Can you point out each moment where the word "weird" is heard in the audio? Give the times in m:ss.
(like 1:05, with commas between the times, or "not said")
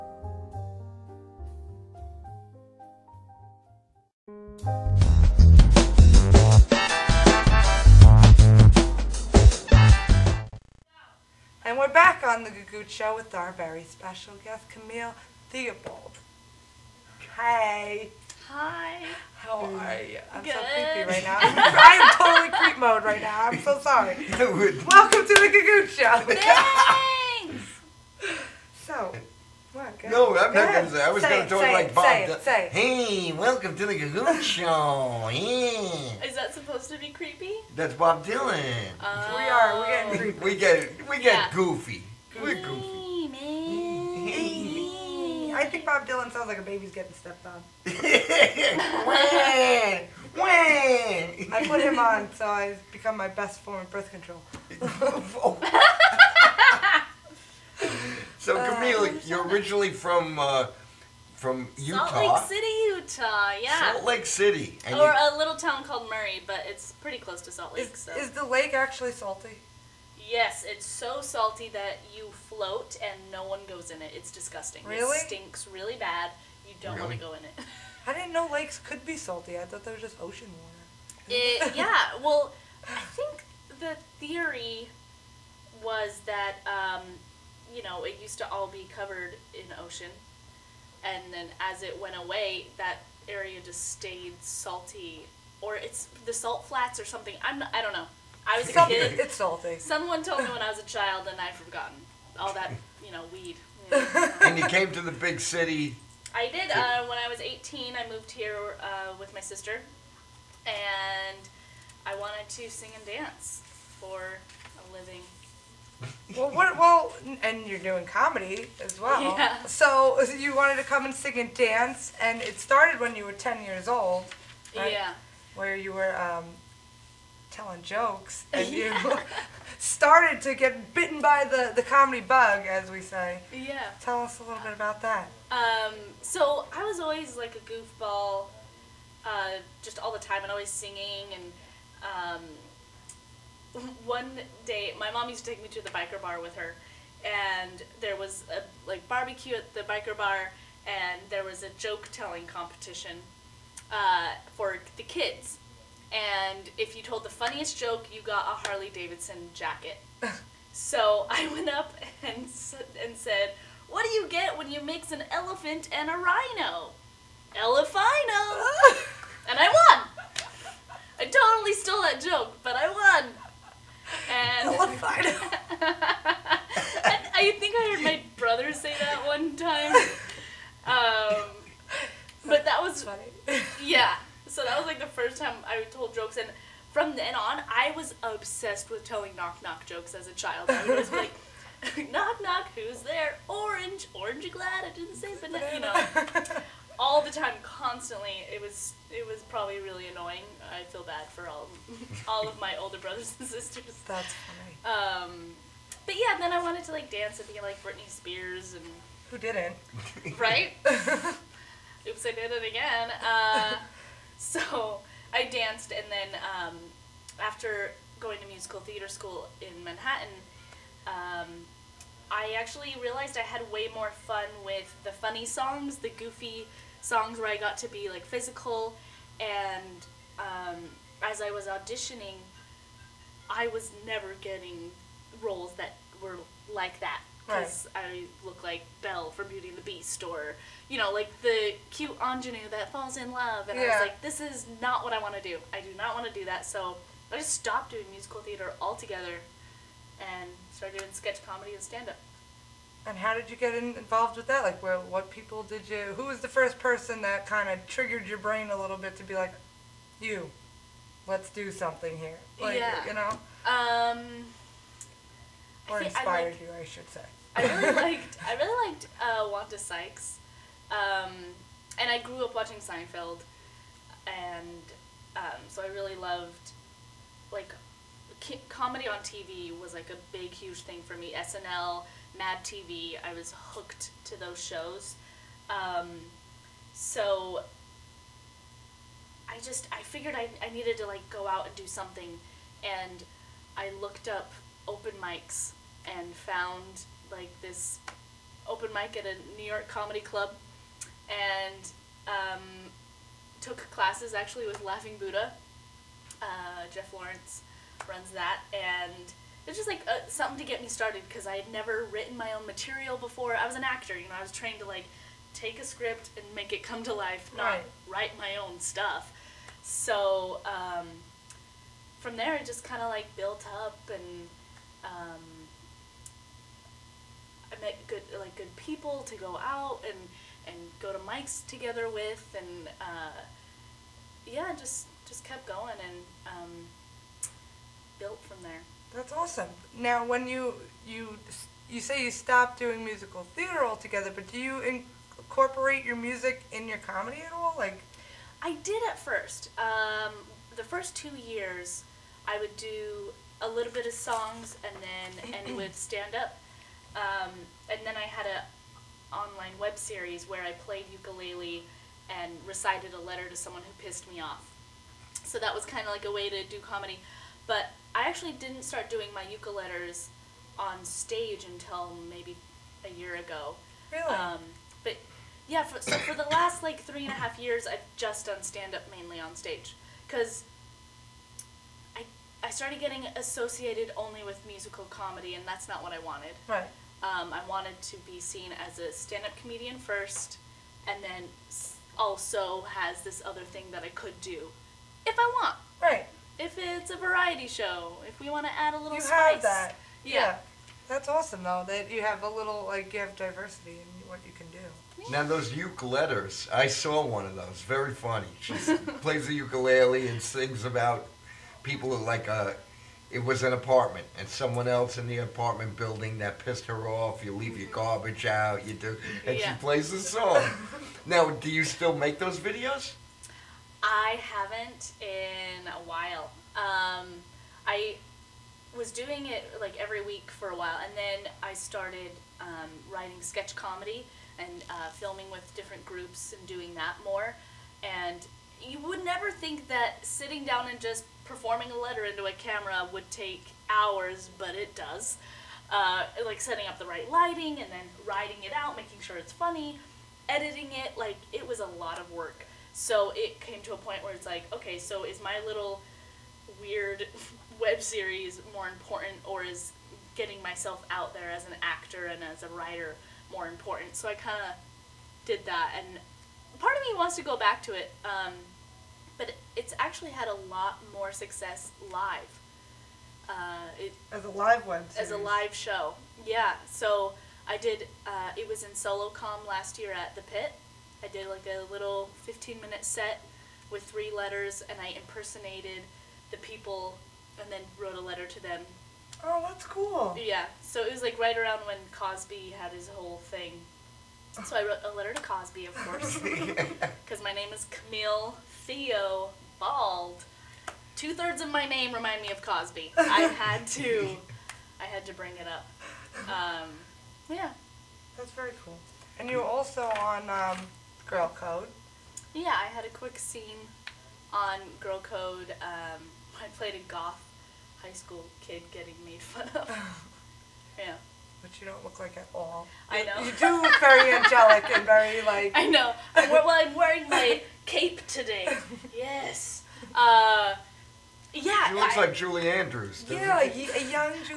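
7:36.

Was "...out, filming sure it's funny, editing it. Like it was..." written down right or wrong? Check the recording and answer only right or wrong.
wrong.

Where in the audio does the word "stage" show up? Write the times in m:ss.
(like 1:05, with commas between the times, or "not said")
6:11, 6:19.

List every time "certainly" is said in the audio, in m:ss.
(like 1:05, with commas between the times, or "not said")
not said.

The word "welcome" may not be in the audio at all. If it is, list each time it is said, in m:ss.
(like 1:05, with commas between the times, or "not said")
0:24, 0:33.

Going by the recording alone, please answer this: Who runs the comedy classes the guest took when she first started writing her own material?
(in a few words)
Jeff Lawrence.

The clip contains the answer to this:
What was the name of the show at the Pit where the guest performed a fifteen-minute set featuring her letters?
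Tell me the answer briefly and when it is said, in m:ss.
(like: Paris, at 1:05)
SoloCom, at 7:58.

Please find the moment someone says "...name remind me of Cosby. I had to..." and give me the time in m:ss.
8:21.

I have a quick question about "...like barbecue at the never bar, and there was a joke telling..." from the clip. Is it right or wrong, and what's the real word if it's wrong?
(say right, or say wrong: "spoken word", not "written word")
wrong: "biker", not "never".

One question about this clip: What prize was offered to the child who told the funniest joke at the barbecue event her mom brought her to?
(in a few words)
Harley Davidson jacket.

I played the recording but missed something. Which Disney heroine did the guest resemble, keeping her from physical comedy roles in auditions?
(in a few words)
Belle.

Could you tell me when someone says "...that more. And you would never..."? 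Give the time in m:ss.
7:16.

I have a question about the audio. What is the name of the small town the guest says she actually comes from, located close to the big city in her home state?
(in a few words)
Murray.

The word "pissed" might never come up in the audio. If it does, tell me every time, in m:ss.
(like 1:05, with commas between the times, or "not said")
6:04, 6:56.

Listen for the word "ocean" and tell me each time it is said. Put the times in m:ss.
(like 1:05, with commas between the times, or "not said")
1:20, 1:29.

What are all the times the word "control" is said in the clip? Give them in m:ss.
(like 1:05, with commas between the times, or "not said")
0:54.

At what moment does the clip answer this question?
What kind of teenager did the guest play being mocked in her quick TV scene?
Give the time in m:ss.
8:37.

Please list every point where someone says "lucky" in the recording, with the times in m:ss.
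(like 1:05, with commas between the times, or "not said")
not said.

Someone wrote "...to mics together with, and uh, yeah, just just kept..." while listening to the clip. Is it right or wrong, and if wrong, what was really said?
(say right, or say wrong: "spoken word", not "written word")
right.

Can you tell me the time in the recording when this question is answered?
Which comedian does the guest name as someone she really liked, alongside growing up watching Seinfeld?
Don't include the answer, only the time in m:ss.
4:29.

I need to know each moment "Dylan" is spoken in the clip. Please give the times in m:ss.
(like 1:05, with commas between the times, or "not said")
0:38, 0:46.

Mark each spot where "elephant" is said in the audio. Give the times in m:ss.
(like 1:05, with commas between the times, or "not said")
2:45.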